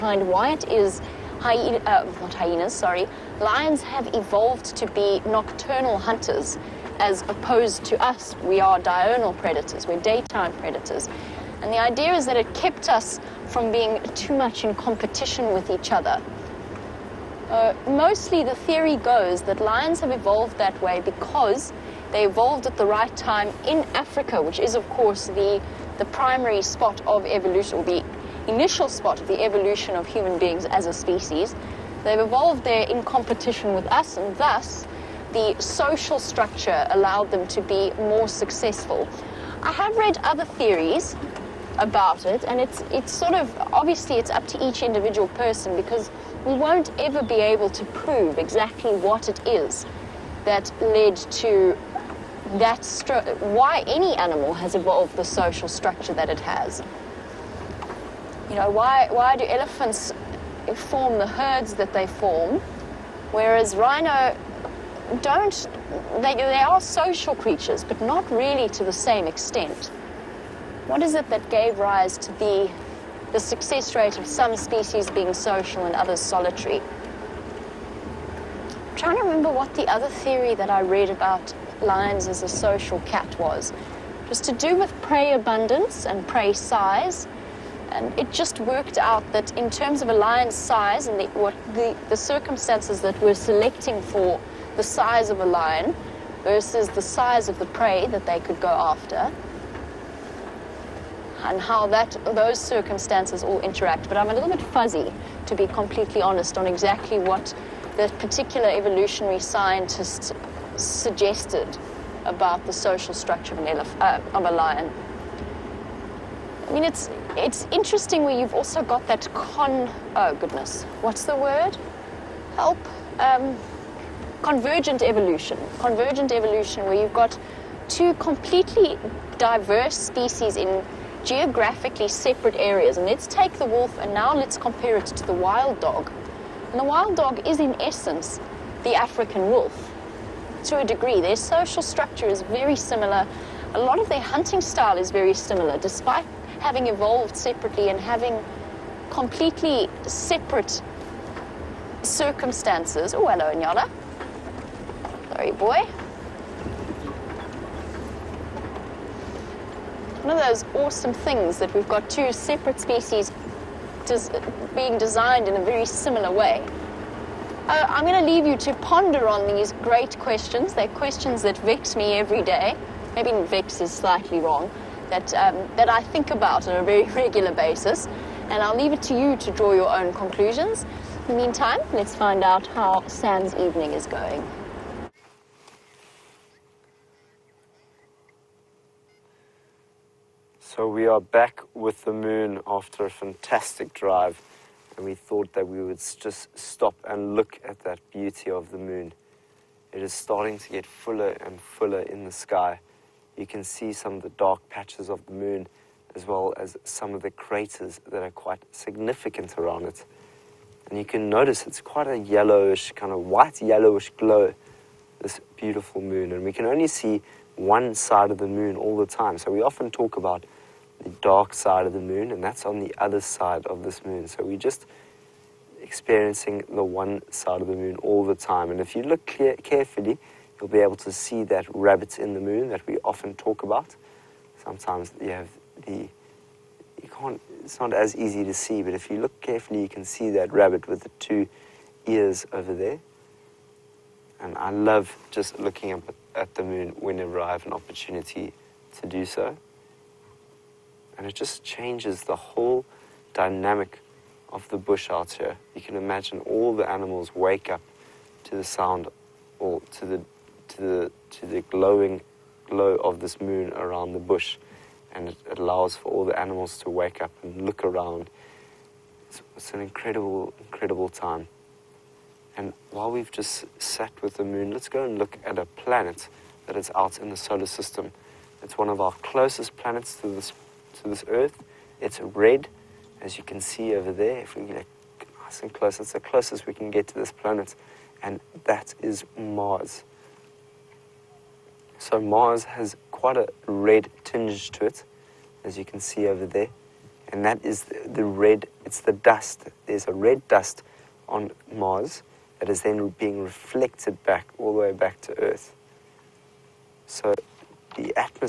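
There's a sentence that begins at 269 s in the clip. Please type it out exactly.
It's, it's an incredible, incredible time.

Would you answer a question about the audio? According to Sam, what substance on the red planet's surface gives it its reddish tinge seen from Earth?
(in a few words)
red dust.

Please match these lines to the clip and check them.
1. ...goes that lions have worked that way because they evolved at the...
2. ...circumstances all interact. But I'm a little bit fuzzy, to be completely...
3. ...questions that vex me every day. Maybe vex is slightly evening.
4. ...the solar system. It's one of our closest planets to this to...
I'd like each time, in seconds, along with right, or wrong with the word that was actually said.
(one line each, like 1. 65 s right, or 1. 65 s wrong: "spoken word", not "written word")
1. 18 s wrong: "evolved", not "worked"
2. 102 s right
3. 170 s wrong: "wrong", not "evening"
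4. 277 s right.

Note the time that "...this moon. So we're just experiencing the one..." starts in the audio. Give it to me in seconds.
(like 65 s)
223 s.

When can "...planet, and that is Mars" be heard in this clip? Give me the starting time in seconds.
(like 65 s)
287 s.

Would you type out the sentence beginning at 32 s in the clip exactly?
They've evolved there in competition with us, and thus the social structure allowed them to be more successful.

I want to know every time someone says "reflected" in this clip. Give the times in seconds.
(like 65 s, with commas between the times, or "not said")
303 s.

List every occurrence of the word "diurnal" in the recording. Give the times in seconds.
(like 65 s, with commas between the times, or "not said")
8 s.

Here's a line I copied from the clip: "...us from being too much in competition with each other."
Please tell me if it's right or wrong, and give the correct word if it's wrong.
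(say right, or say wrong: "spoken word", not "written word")
right.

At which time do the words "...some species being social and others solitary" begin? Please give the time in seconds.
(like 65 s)
74 s.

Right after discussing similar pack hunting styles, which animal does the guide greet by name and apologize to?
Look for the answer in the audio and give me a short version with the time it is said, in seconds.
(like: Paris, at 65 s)
Nyala, at 153 s.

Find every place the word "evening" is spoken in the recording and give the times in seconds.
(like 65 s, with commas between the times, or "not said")
183 s.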